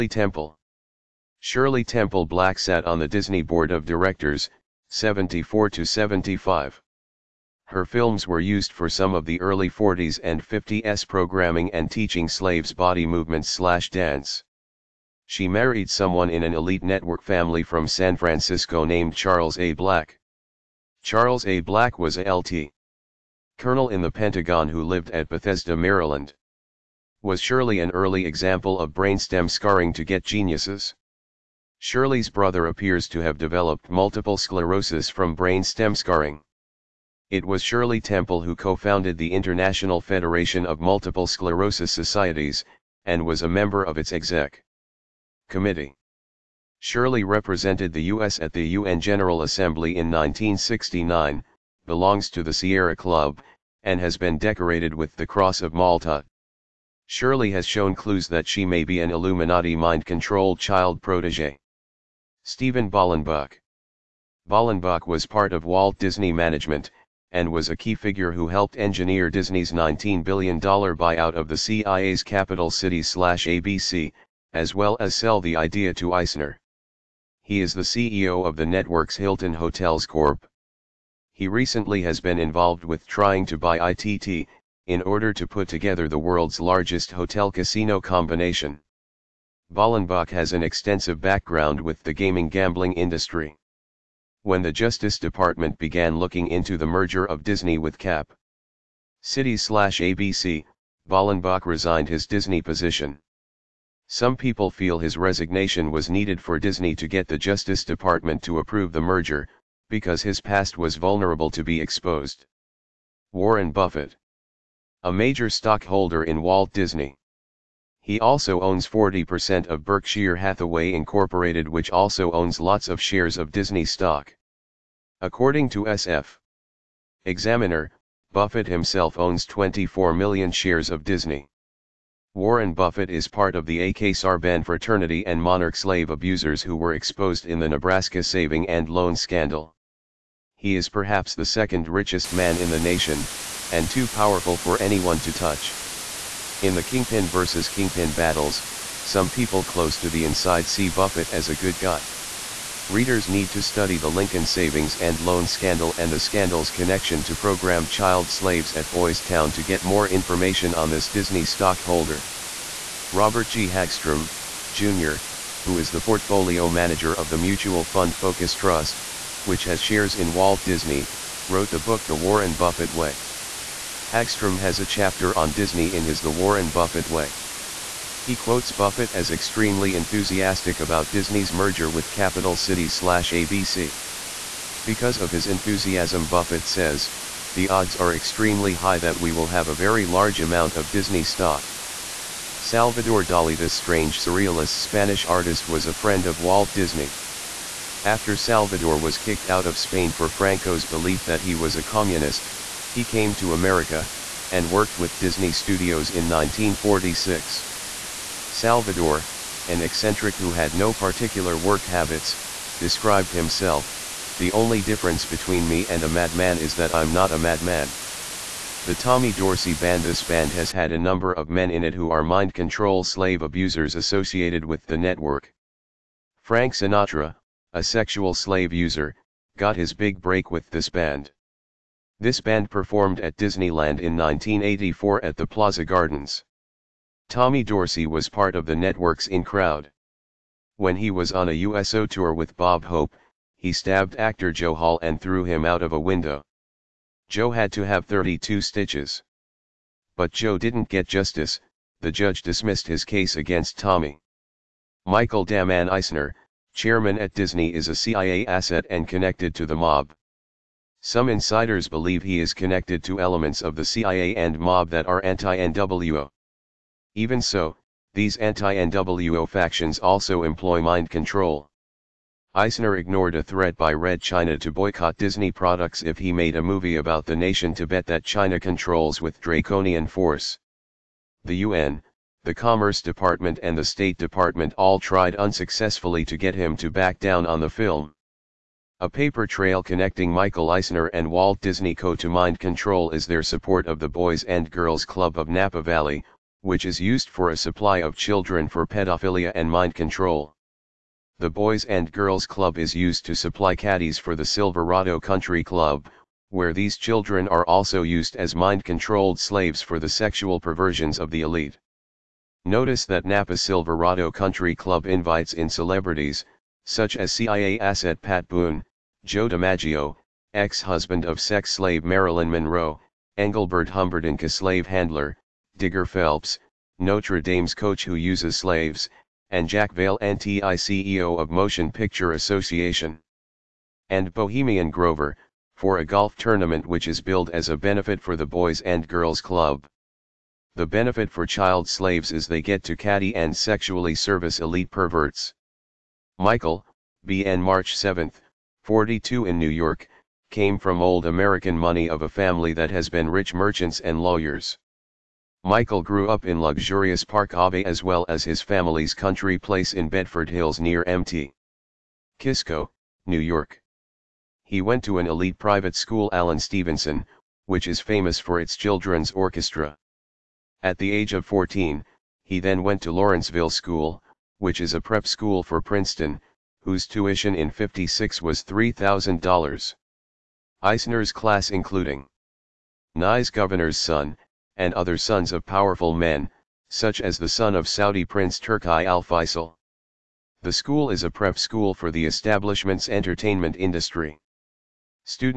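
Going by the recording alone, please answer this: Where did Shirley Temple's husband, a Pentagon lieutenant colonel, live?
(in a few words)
Bethesda, Maryland.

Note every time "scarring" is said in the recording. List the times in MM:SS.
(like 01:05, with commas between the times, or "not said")
00:29, 00:35.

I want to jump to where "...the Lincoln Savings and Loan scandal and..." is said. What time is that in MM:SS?
02:33.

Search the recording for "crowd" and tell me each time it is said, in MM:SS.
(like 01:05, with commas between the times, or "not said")
03:59.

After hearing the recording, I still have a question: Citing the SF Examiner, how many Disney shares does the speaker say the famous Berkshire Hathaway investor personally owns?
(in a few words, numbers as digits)
24 million.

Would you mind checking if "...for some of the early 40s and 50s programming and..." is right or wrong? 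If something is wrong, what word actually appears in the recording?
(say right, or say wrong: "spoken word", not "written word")
right.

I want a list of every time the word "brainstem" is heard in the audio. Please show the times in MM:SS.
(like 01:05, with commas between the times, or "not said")
00:28, 00:35.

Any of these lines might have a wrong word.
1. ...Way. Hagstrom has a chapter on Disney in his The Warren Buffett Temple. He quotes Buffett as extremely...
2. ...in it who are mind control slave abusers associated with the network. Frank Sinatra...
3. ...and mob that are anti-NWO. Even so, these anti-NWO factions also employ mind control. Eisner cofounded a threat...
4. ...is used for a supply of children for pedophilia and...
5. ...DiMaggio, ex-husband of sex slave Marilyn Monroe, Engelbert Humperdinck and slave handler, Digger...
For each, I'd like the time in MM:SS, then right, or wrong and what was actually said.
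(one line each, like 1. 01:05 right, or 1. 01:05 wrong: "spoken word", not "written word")
1. 02:52 wrong: "Way", not "Temple"
2. 03:41 right
3. 04:24 wrong: "ignored", not "cofounded"
4. 04:56 right
5. 05:19 right.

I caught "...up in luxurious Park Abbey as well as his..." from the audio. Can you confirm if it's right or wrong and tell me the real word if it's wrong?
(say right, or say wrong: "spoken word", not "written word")
right.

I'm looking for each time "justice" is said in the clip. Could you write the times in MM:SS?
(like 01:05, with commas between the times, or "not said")
01:34, 01:47, 04:11.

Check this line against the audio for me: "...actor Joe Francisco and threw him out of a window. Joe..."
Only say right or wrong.
wrong.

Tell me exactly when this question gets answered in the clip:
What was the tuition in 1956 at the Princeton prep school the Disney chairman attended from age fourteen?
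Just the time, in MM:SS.
06:18.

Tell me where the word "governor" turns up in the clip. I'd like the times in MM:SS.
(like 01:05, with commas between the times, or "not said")
06:23.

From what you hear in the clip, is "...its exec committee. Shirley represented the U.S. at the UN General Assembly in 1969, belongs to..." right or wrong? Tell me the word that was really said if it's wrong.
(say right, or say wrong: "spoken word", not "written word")
right.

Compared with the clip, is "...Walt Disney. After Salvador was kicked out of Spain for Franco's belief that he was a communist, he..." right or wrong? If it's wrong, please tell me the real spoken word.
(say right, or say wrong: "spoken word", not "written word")
right.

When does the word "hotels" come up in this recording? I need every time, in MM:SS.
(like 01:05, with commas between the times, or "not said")
01:19, 01:27.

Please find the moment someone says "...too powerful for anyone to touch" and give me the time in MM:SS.
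02:23.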